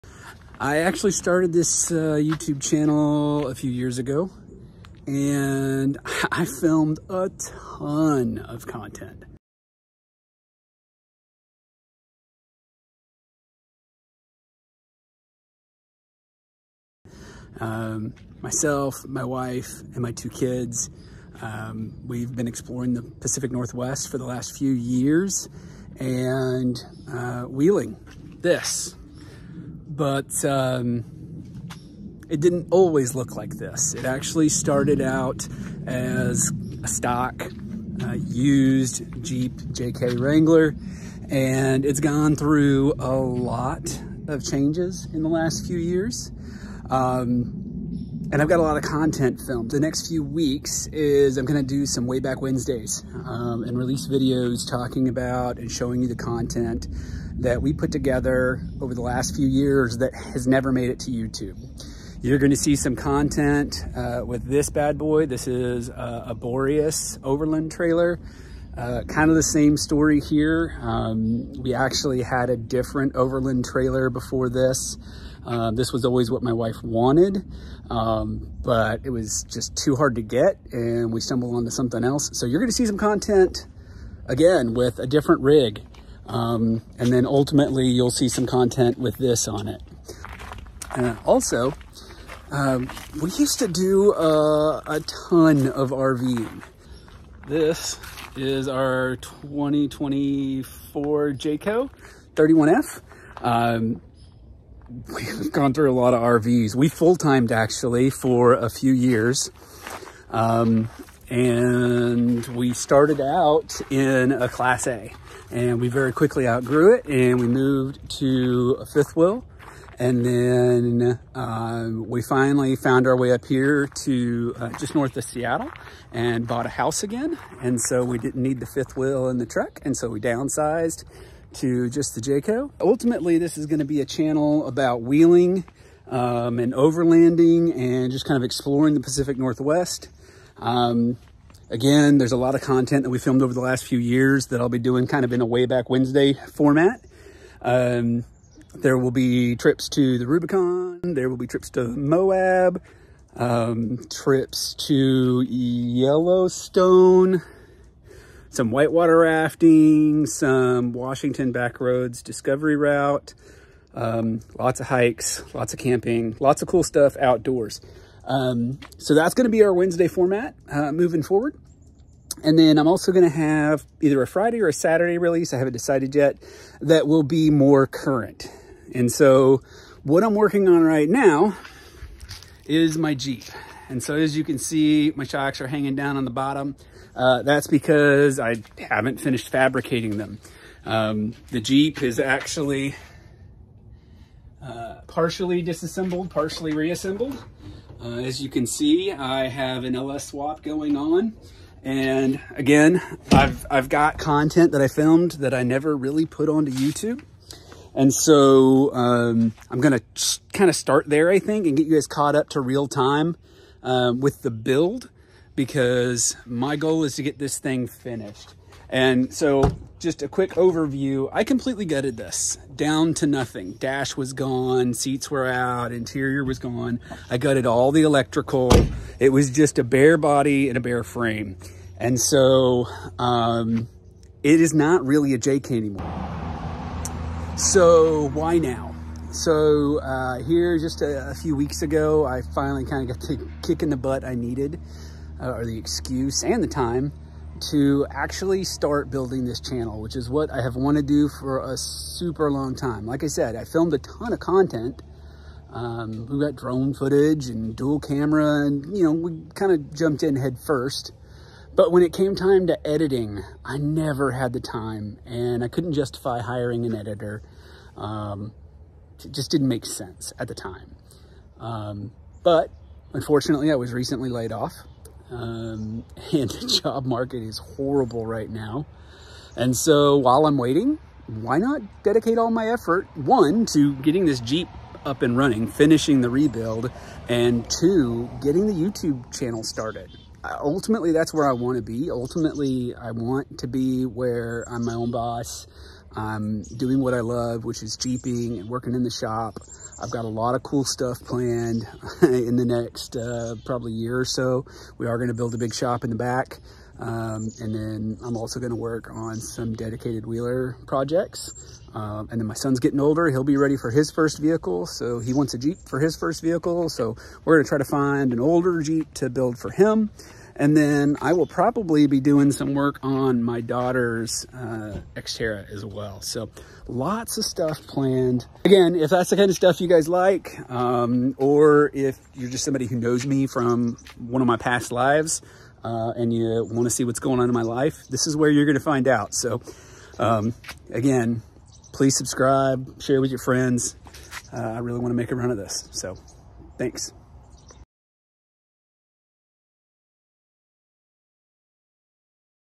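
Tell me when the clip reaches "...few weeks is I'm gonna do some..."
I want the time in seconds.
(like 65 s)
50 s.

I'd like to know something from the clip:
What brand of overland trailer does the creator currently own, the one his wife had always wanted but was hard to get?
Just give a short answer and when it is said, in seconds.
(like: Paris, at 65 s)
Boreas, at 66 s.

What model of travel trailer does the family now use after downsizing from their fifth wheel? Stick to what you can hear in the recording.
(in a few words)
Jayco 31F.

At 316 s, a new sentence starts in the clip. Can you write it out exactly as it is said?
So we're going to try to find an older Jeep to build for him.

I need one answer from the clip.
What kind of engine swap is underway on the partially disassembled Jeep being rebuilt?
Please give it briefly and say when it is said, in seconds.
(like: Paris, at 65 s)
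LS swap, at 199 s.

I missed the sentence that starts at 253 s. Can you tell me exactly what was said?
Like I said, I filmed a ton of content.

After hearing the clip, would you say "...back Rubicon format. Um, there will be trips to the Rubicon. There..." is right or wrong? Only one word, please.
wrong.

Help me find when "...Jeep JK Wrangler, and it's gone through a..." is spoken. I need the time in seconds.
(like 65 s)
39 s.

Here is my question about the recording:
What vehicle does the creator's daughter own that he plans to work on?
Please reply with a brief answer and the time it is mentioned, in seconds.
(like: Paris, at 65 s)
Xterra, at 325 s.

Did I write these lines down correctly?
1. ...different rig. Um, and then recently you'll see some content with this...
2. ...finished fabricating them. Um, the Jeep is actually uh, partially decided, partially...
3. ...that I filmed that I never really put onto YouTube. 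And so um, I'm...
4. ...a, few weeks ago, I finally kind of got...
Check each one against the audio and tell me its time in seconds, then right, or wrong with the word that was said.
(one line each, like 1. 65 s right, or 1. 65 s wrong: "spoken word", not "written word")
1. 85 s wrong: "ultimately", not "recently"
2. 189 s wrong: "disassembled", not "decided"
3. 204 s right
4. 241 s right.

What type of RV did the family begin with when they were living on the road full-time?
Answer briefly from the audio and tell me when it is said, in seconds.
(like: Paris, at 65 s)
Class A, at 114 s.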